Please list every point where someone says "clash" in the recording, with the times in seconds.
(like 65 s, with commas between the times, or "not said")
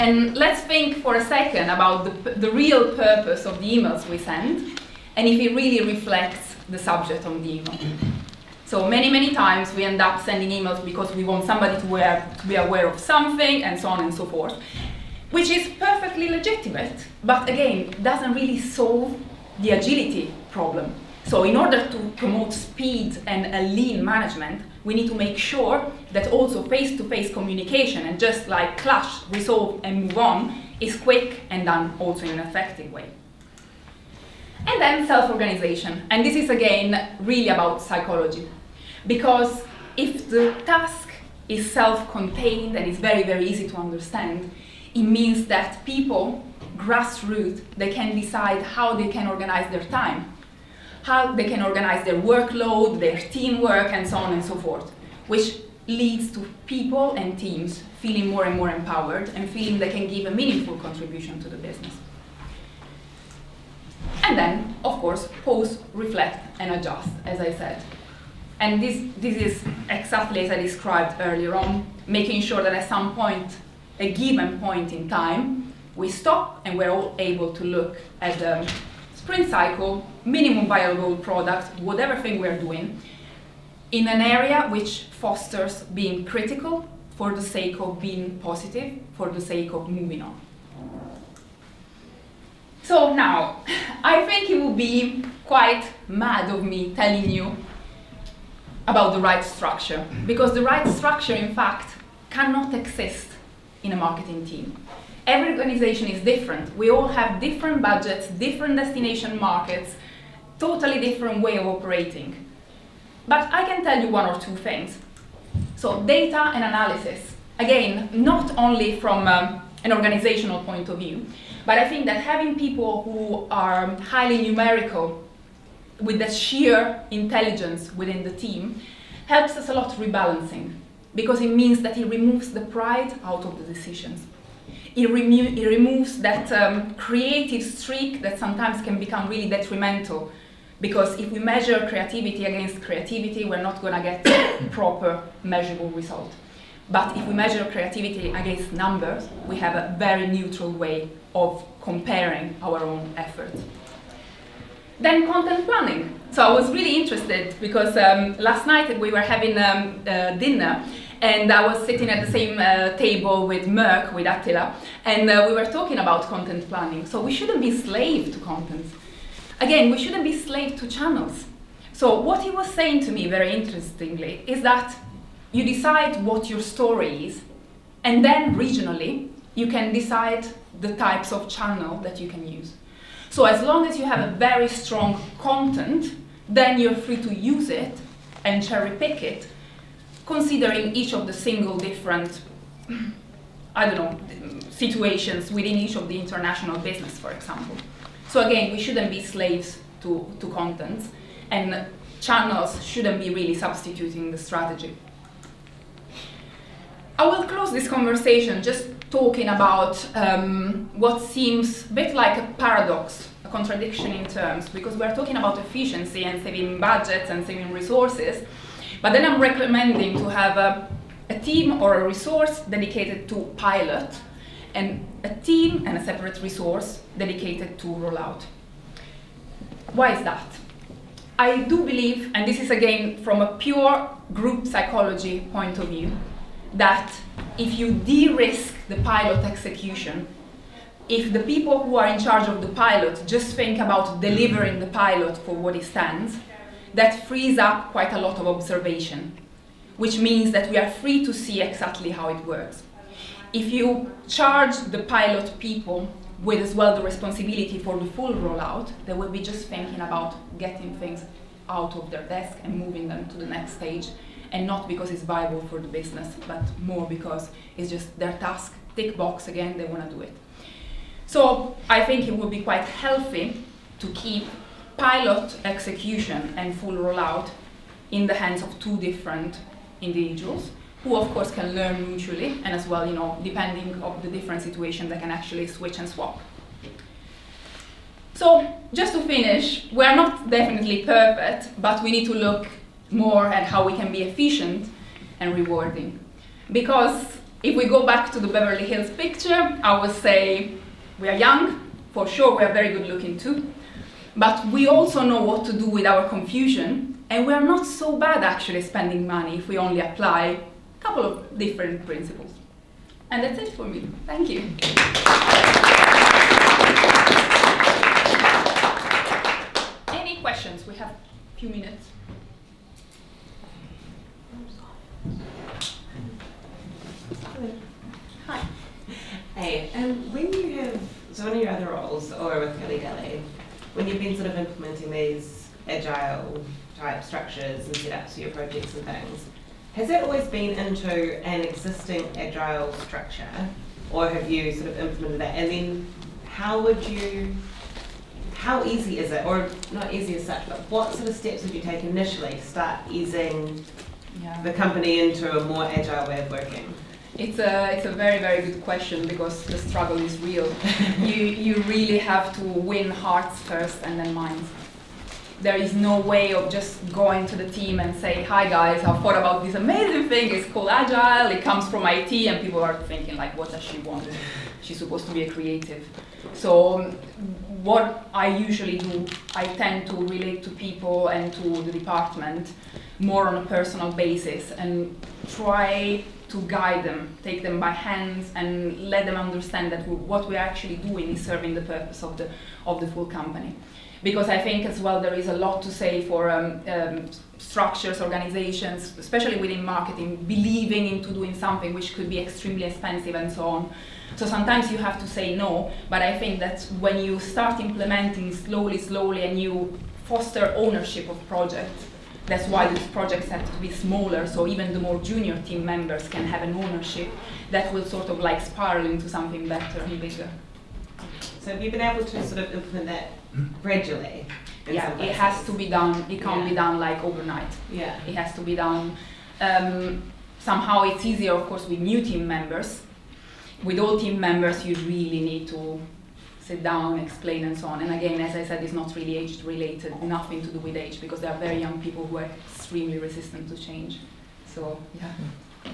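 28 s.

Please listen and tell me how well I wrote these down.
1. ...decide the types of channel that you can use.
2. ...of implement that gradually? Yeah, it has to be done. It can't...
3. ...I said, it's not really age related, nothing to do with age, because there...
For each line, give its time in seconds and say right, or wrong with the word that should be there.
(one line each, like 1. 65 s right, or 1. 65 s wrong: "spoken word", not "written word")
1. 179 s right
2. 422 s right
3. 438 s right.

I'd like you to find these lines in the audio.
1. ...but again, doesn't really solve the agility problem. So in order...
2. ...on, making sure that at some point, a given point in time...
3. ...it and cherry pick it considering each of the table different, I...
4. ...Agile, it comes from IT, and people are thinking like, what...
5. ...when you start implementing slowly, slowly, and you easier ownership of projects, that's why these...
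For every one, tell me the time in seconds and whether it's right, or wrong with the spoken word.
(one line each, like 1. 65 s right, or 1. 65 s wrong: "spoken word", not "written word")
1. 17 s right
2. 71 s right
3. 187 s wrong: "single", not "table"
4. 370 s right
5. 406 s wrong: "foster", not "easier".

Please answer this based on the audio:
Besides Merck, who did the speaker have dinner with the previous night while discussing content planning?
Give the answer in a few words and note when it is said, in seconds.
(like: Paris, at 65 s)
Attila, at 164 s.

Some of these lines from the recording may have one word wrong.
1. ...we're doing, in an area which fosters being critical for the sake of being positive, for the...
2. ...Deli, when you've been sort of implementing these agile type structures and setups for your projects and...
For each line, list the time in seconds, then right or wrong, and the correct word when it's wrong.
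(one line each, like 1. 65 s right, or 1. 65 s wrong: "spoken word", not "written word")
1. 82 s right
2. 332 s right.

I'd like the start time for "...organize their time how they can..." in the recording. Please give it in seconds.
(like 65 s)
49 s.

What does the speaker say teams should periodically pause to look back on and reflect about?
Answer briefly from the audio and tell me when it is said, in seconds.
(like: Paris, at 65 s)
print cycle, at 79 s.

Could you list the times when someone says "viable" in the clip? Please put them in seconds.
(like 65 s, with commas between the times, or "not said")
80 s, 265 s.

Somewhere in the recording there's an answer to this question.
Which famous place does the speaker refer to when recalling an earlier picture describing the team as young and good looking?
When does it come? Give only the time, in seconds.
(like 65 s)
298 s.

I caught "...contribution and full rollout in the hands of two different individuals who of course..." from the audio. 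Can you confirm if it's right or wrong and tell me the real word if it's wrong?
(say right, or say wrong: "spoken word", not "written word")
wrong: "execution", not "contribution".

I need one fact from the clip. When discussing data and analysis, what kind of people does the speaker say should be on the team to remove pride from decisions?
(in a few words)
highly numerical.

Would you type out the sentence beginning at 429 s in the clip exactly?
Um, somehow it's easier, of course, with new team members.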